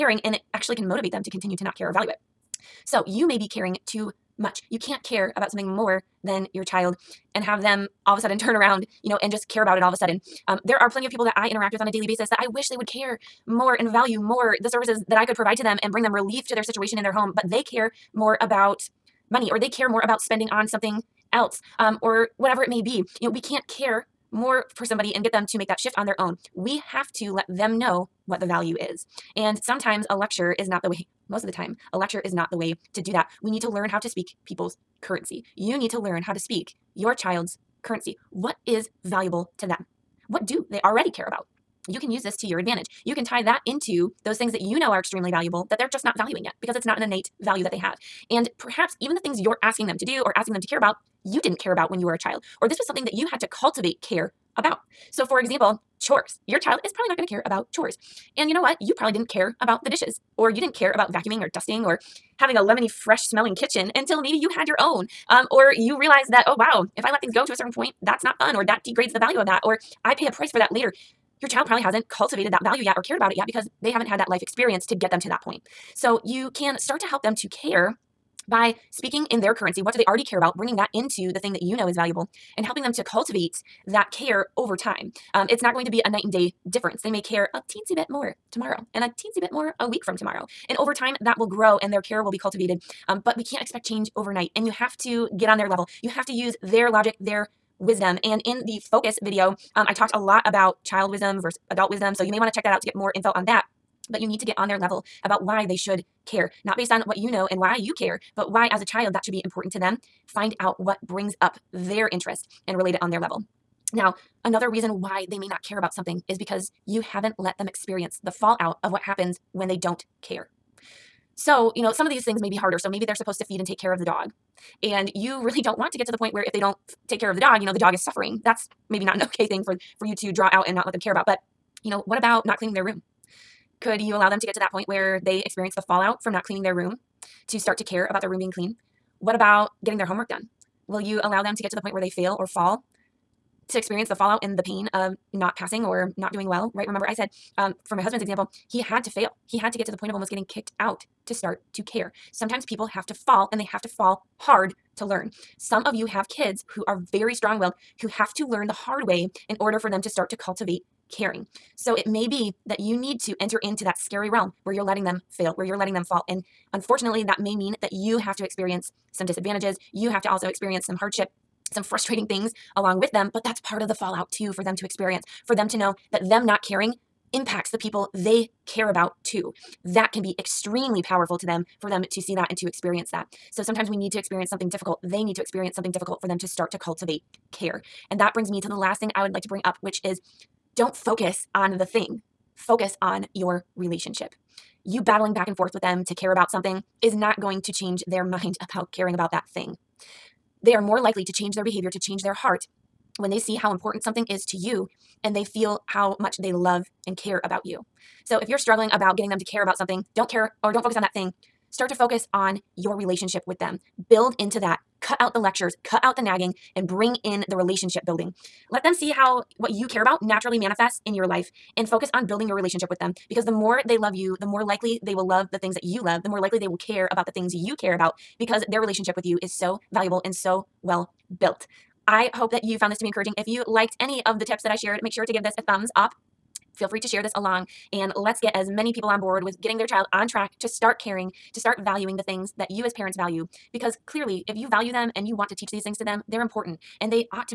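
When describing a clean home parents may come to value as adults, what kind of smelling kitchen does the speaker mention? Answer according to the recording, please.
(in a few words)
Lemony, fresh smelling.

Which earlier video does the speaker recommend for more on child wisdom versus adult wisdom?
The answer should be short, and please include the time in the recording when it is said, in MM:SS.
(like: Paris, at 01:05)
The focus video, at 01:38.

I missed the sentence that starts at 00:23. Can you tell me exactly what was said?
You know, we can't care more for somebody and get them to make that shift on their own.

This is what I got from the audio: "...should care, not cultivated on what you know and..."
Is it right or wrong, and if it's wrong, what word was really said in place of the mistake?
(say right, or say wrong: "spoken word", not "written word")
wrong: "based", not "cultivated".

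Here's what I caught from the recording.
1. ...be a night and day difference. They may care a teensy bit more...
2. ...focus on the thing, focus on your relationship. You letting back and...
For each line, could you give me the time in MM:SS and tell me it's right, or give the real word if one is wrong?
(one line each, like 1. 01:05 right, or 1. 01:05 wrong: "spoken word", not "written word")
1. 01:25 right
2. 03:10 wrong: "battling", not "letting".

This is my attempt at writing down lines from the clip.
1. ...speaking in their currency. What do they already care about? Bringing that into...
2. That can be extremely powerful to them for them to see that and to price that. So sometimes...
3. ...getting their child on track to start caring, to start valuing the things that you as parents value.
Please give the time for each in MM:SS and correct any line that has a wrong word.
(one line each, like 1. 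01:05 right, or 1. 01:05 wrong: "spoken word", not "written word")
1. 01:18 right
2. 02:59 wrong: "experience", not "price"
3. 03:59 right.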